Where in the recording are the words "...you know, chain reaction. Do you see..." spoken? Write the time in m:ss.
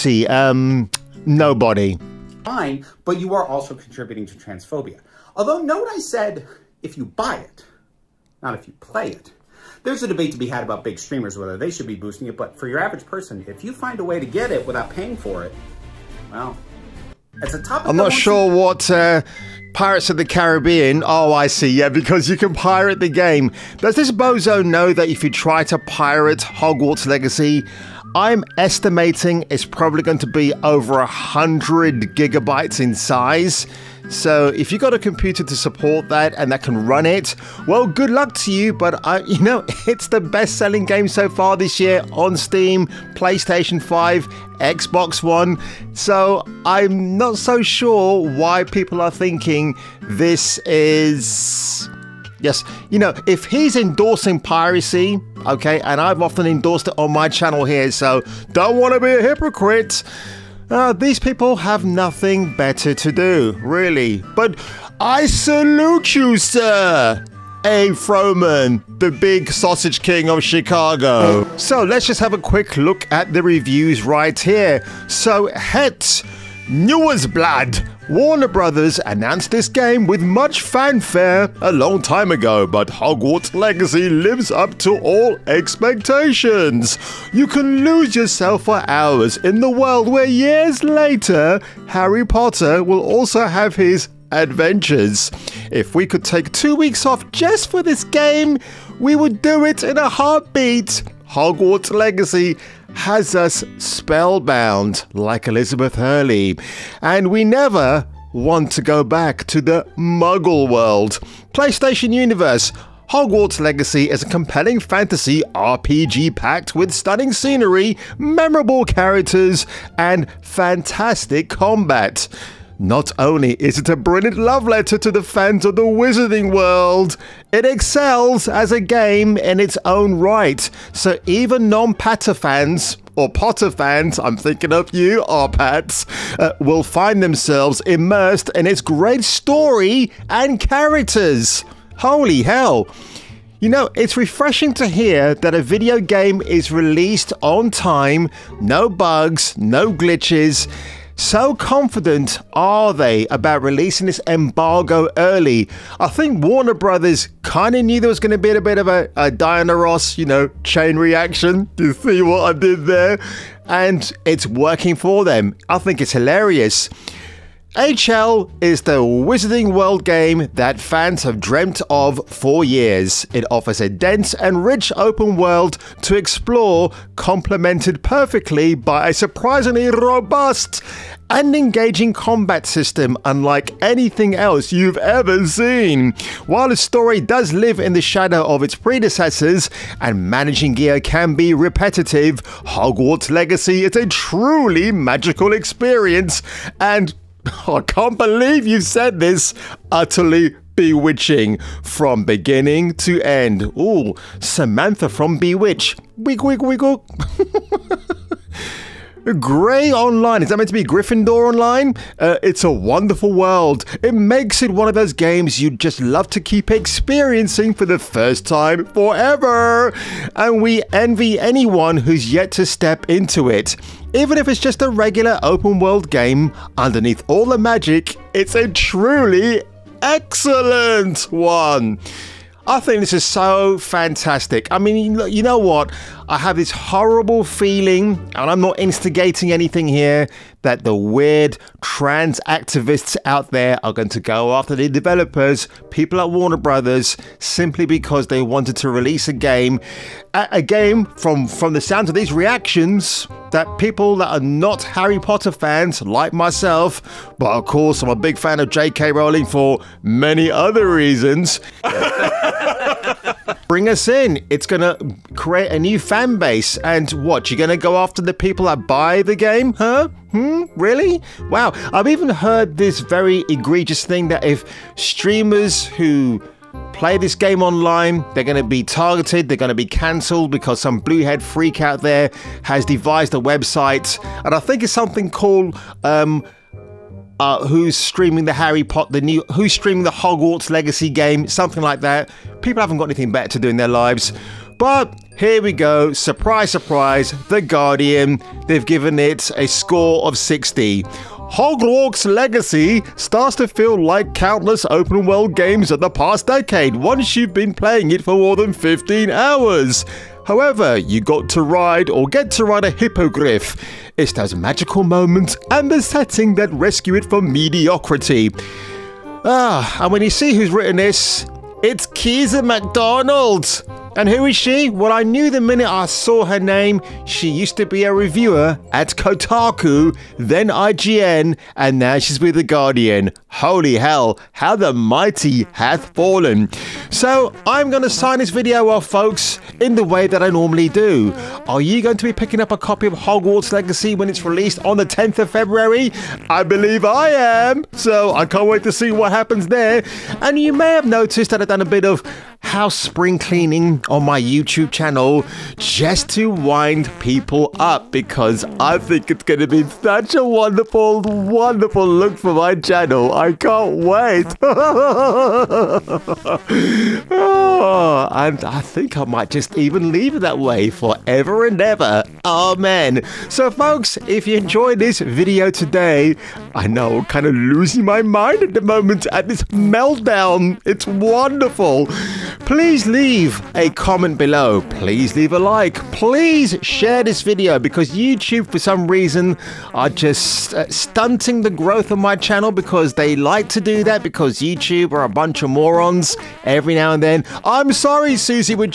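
2:40.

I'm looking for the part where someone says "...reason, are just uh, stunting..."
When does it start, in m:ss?
6:29.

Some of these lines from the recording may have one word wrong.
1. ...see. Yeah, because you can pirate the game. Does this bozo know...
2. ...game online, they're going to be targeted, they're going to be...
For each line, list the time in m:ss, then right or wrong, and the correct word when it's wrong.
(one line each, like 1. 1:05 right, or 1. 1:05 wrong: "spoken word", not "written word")
1. 0:21 right
2. 4:37 right.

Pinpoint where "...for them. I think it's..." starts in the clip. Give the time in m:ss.
2:44.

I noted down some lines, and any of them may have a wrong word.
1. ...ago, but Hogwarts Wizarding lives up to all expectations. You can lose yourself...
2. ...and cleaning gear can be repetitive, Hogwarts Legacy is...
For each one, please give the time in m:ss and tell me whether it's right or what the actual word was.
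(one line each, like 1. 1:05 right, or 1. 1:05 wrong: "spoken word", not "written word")
1. 1:22 wrong: "Legacy", not "Wizarding"
2. 3:09 wrong: "managing", not "cleaning".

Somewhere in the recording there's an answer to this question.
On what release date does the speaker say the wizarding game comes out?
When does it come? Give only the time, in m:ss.
5:45.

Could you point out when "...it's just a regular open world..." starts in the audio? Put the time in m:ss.
3:44.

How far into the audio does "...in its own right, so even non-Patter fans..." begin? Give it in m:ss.
2:09.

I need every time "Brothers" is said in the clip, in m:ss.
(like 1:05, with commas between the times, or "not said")
1:18, 2:36, 4:06.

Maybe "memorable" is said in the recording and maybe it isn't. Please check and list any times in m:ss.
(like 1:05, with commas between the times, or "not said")
1:58.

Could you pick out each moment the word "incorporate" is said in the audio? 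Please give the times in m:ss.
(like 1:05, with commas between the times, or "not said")
not said.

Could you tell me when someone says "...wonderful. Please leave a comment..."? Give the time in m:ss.
6:21.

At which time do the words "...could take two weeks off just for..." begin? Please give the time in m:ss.
1:36.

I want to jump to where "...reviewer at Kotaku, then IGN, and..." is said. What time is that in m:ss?
5:28.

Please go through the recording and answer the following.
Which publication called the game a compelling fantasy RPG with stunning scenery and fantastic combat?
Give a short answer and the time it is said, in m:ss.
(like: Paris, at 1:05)
PlayStation Universe, at 1:51.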